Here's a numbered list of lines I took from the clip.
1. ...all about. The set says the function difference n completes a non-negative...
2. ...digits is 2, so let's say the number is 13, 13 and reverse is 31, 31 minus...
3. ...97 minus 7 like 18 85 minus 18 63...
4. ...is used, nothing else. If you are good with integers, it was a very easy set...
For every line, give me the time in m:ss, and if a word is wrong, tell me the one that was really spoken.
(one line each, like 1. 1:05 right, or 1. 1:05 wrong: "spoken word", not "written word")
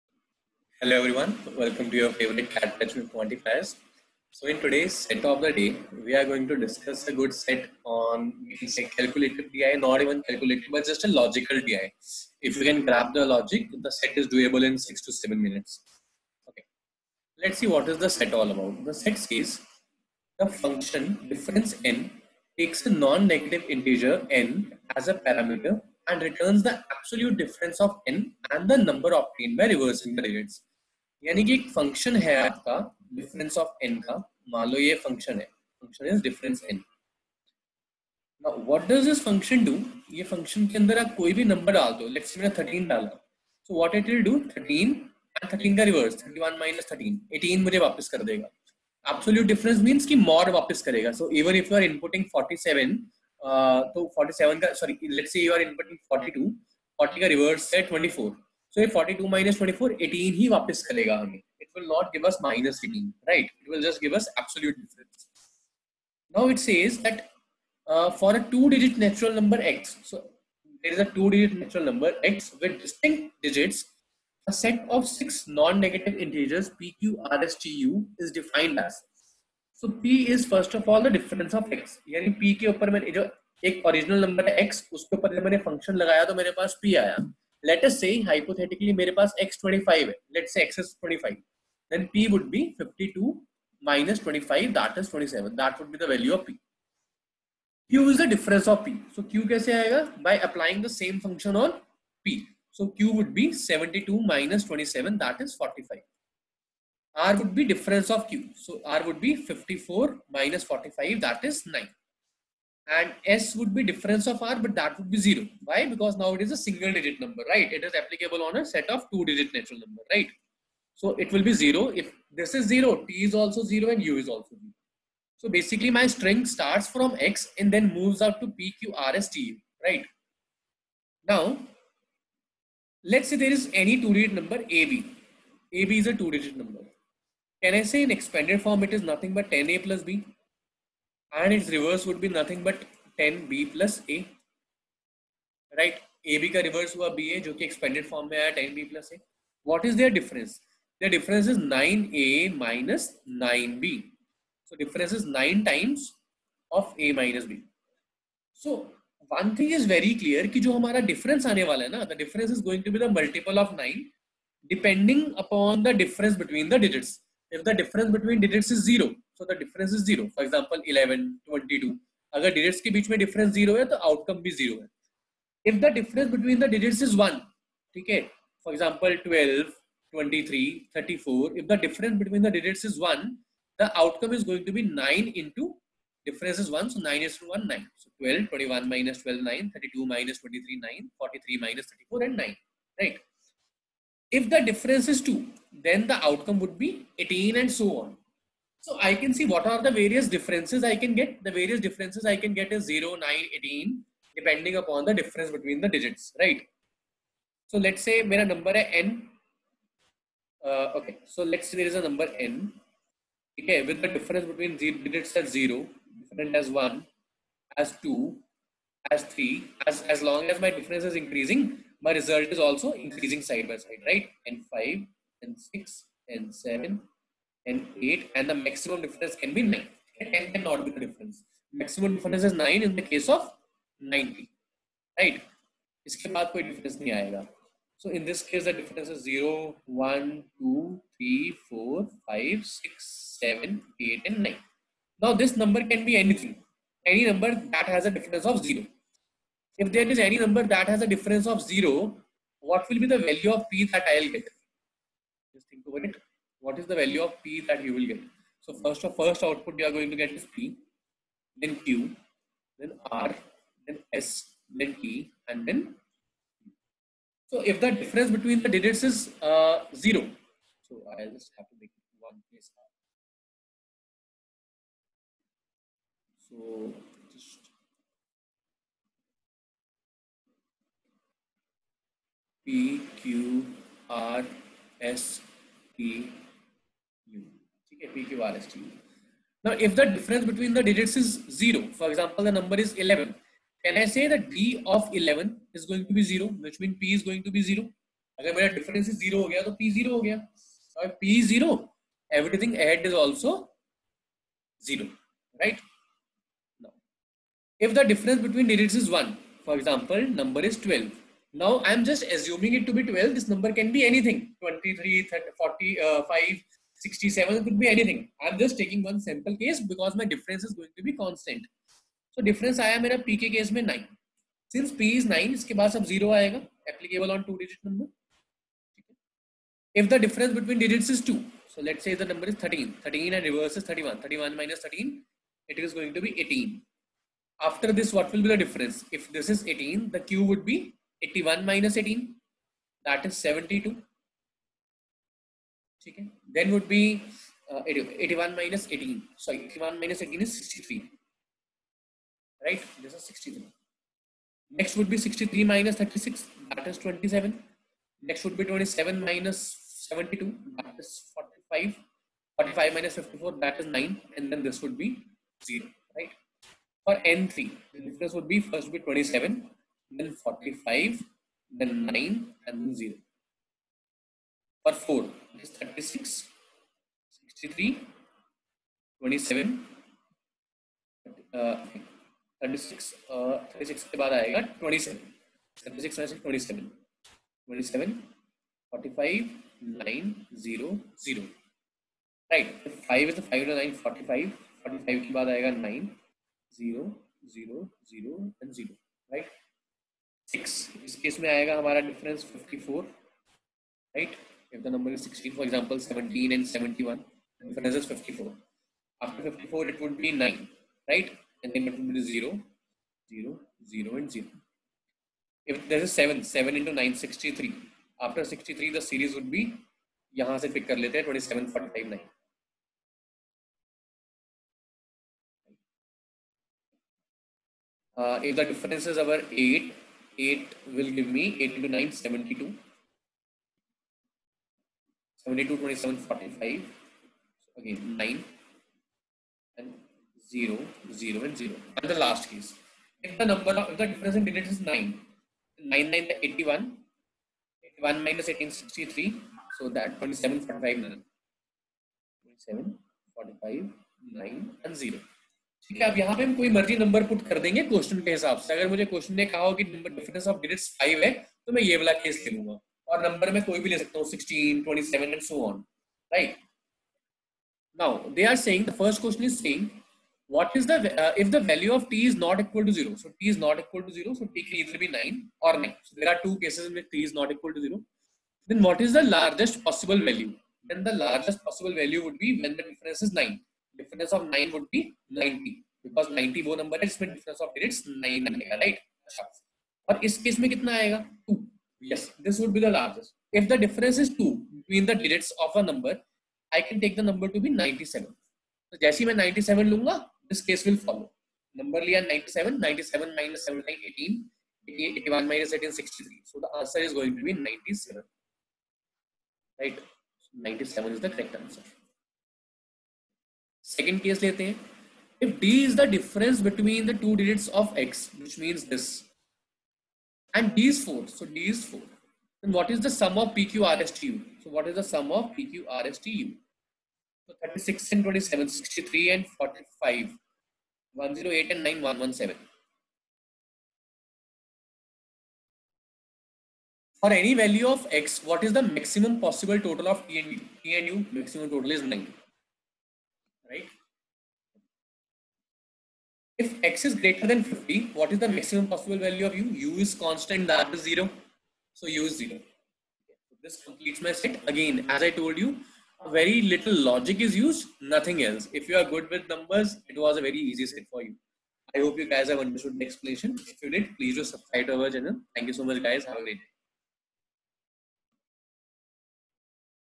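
1. 0:18 wrong: "takes", not "completes"
2. 5:30 right
3. 8:22 wrong: "81", not "85"
4. 9:17 wrong: "numbers", not "integers".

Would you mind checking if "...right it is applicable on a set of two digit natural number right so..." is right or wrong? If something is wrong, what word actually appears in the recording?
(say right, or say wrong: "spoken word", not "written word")
right.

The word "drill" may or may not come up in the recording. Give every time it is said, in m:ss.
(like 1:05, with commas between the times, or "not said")
not said.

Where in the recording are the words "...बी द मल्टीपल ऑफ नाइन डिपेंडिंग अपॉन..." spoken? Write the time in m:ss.
2:42.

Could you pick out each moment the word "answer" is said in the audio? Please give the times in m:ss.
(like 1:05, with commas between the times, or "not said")
8:26, 8:31.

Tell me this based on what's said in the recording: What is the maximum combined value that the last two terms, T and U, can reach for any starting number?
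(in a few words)
9.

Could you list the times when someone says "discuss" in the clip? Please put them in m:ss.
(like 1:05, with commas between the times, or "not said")
0:06.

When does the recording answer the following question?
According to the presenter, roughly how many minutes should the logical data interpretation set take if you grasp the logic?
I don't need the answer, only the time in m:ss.
0:14.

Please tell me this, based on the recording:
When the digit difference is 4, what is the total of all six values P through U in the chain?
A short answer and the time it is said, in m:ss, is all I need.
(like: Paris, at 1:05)
117, at 8:52.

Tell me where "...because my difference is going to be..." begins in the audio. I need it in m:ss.
5:19.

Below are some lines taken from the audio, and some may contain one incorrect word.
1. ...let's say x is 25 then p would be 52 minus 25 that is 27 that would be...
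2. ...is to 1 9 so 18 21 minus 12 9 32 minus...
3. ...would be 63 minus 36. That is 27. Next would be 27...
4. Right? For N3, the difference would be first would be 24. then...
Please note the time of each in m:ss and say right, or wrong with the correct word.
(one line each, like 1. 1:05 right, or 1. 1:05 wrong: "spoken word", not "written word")
1. 1:30 right
2. 3:07 wrong: "12", not "18"
3. 5:54 right
4. 6:06 wrong: "27", not "24".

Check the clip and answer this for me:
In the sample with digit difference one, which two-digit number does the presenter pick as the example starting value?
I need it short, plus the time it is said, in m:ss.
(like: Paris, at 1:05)
12, at 5:10.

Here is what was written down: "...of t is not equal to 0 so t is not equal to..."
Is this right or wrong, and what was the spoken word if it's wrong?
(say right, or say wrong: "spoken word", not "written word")
right.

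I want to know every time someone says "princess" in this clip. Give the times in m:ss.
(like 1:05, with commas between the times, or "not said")
not said.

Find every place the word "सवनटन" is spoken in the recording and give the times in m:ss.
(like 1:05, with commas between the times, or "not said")
6:46.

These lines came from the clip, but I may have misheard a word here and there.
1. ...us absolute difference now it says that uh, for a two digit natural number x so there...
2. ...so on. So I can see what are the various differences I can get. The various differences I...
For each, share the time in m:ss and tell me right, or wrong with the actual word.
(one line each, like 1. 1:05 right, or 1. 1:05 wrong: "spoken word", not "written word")
1. 1:04 right
2. 3:17 right.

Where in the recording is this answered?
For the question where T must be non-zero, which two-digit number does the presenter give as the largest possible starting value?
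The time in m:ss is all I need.
8:30.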